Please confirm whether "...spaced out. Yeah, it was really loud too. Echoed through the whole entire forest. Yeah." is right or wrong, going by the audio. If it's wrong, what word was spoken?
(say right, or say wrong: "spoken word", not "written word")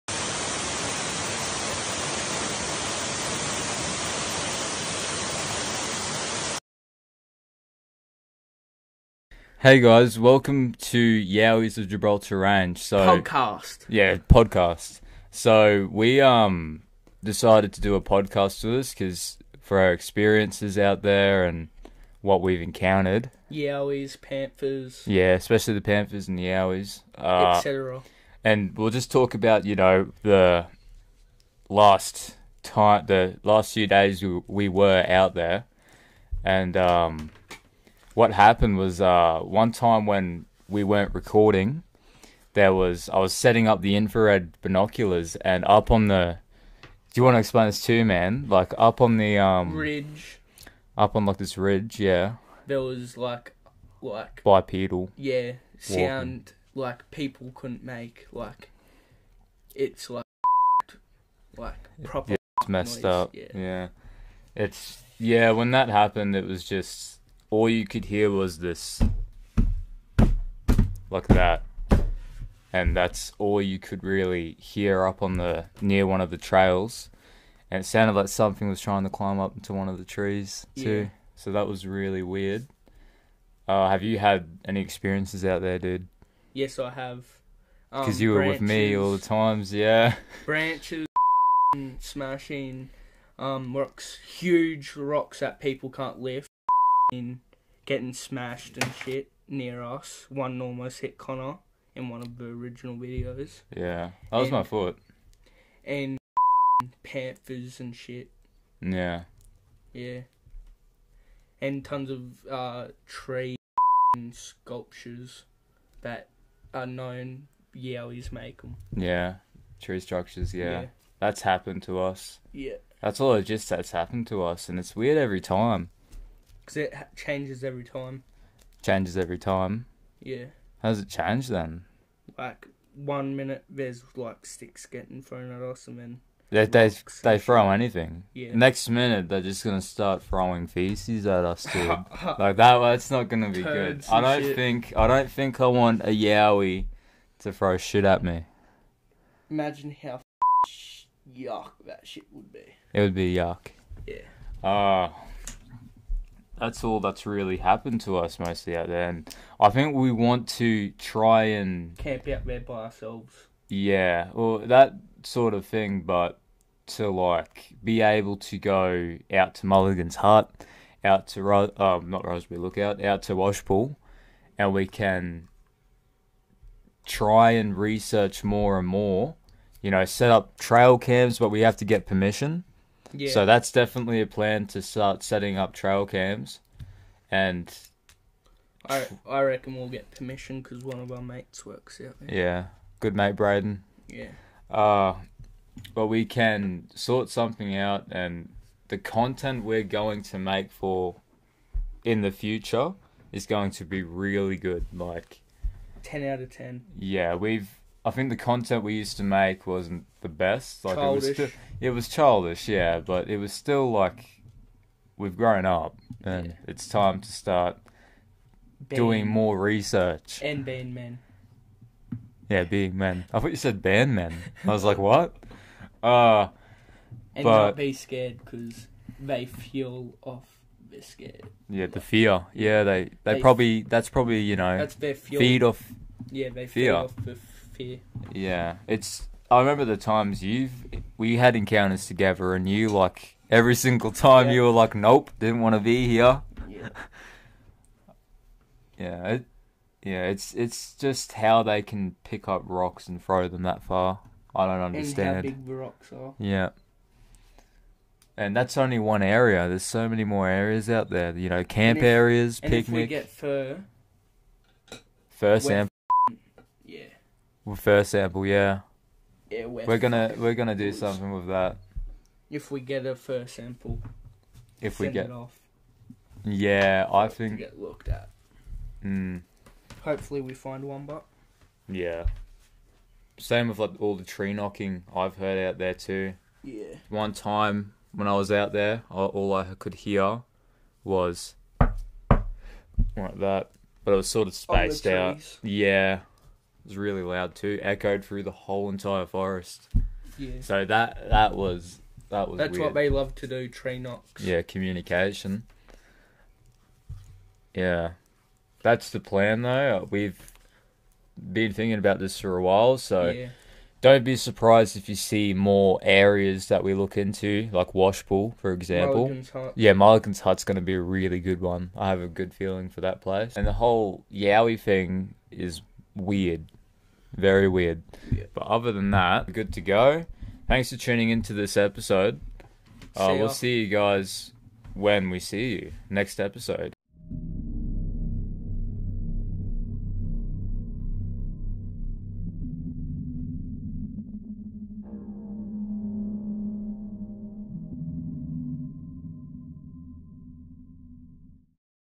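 right.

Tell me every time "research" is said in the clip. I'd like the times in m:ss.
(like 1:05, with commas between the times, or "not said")
2:57, 3:39.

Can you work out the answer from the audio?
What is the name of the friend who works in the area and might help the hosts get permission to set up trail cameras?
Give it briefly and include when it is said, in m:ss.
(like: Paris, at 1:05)
Braden, at 3:13.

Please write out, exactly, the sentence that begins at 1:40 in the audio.
One almost hit Connor in one of the original videos.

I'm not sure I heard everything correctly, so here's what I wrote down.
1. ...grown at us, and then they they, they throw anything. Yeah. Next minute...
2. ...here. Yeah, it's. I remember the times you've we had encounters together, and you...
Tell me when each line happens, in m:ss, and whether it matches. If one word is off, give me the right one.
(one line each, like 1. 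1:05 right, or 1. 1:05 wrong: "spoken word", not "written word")
1. 2:15 wrong: "thrown", not "grown"
2. 3:57 right.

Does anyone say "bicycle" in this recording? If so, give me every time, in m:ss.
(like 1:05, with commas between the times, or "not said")
not said.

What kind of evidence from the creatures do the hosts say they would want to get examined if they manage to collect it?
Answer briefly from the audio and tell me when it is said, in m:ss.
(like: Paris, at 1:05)
Fur sample, at 4:25.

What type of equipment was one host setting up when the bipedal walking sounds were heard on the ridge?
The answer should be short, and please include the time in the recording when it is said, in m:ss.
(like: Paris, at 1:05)
Infrared binoculars, at 0:43.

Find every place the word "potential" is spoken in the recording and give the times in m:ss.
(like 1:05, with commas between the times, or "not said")
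not said.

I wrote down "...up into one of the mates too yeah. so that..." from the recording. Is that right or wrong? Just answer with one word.
wrong.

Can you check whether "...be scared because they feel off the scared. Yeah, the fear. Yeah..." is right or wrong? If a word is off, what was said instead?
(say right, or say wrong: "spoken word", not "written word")
right.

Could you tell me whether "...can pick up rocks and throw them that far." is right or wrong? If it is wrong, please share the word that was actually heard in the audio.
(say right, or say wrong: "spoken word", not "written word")
right.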